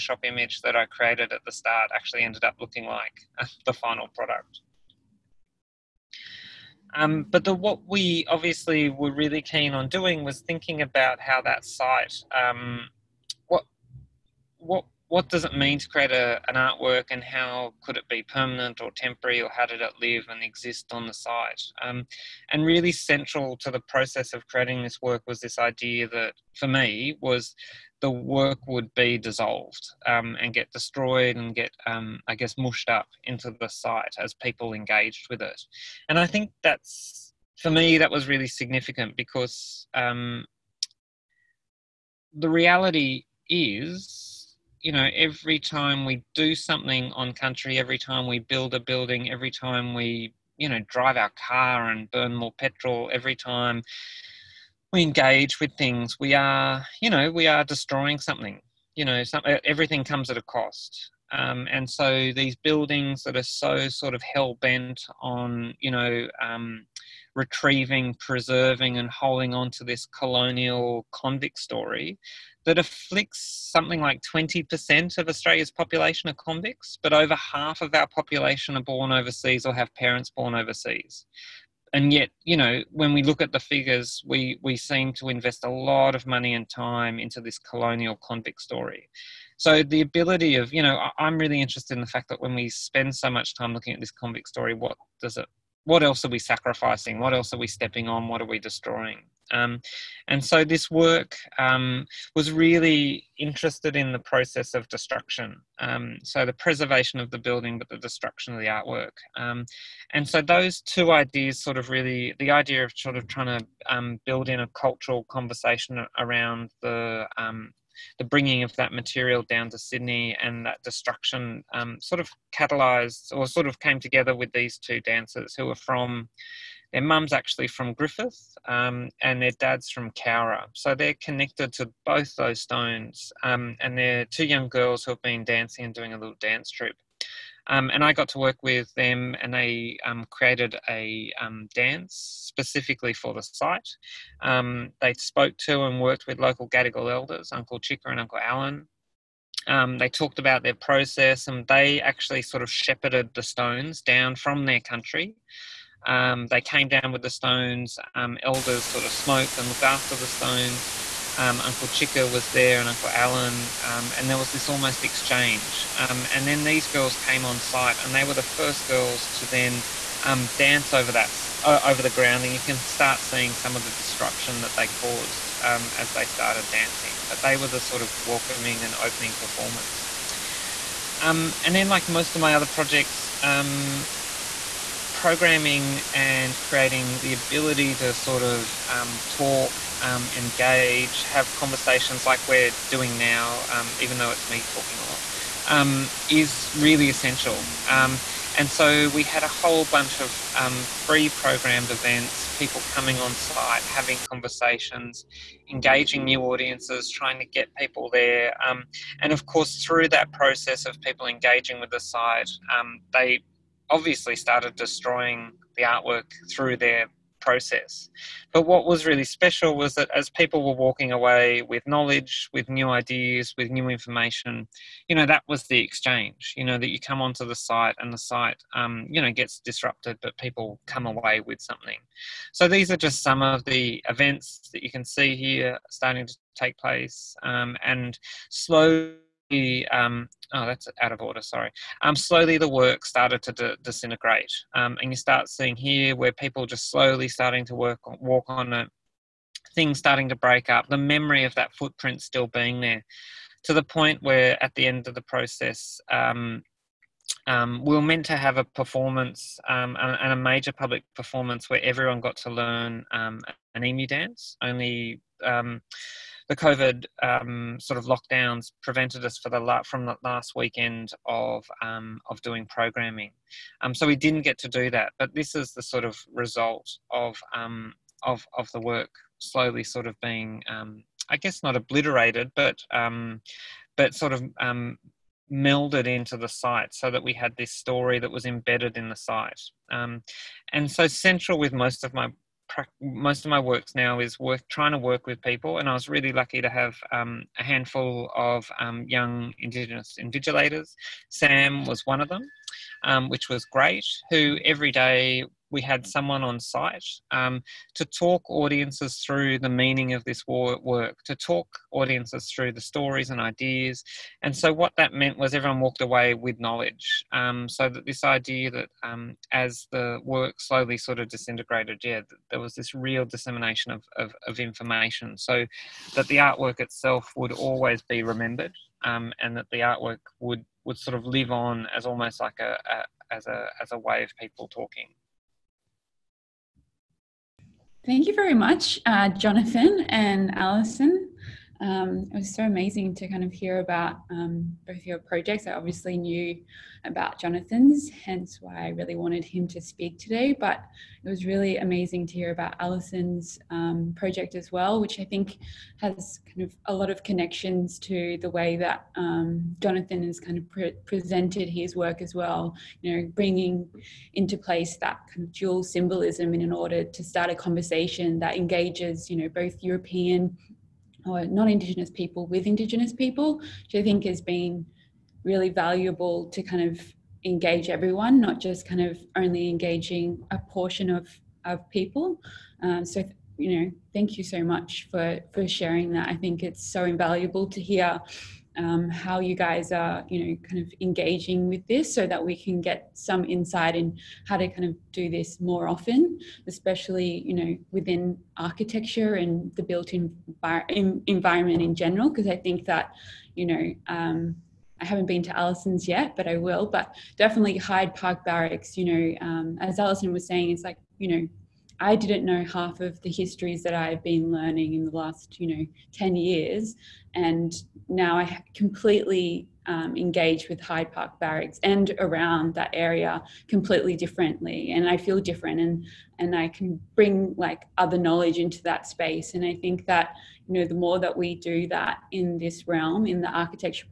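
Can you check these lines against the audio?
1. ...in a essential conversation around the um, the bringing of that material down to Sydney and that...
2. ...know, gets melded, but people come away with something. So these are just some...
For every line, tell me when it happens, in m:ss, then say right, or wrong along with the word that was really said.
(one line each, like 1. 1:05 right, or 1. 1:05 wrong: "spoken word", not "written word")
1. 1:54 wrong: "cultural", not "essential"
2. 3:49 wrong: "disrupted", not "melded".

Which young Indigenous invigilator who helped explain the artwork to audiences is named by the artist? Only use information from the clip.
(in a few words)
Sam.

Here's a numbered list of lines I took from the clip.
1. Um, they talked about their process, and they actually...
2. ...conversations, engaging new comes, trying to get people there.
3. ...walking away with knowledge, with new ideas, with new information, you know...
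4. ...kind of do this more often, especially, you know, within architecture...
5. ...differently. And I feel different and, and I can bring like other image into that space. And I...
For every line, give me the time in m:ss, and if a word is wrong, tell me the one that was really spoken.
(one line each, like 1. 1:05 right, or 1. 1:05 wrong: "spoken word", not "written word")
1. 2:29 right
2. 3:24 wrong: "audiences", not "comes"
3. 3:40 right
4. 6:34 right
5. 7:04 wrong: "knowledge", not "image".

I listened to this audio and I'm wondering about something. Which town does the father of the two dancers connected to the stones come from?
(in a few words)
Cowra.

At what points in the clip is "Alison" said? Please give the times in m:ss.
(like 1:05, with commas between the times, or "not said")
5:40, 5:52, 6:45.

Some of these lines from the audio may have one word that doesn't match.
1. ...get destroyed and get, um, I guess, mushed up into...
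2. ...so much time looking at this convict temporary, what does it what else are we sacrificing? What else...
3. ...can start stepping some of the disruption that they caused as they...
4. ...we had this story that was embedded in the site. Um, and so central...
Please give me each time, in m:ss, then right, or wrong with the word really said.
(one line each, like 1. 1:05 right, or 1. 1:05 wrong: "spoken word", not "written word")
1. 0:30 right
2. 1:33 wrong: "story", not "temporary"
3. 2:52 wrong: "seeing", not "stepping"
4. 4:47 right.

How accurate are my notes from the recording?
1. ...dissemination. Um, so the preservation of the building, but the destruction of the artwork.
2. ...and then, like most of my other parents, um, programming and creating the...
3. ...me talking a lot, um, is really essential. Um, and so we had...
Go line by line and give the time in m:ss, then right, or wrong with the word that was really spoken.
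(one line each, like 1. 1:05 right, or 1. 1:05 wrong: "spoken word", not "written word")
1. 1:44 wrong: "destruction", not "dissemination"
2. 3:01 wrong: "projects", not "parents"
3. 3:14 right.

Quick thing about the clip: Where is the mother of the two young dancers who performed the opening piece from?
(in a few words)
Griffith.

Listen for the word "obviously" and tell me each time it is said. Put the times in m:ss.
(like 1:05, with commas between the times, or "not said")
0:08, 3:33, 5:45.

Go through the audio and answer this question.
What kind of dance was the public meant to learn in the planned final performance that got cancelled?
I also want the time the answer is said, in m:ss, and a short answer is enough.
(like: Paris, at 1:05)
An emu dance, at 4:23.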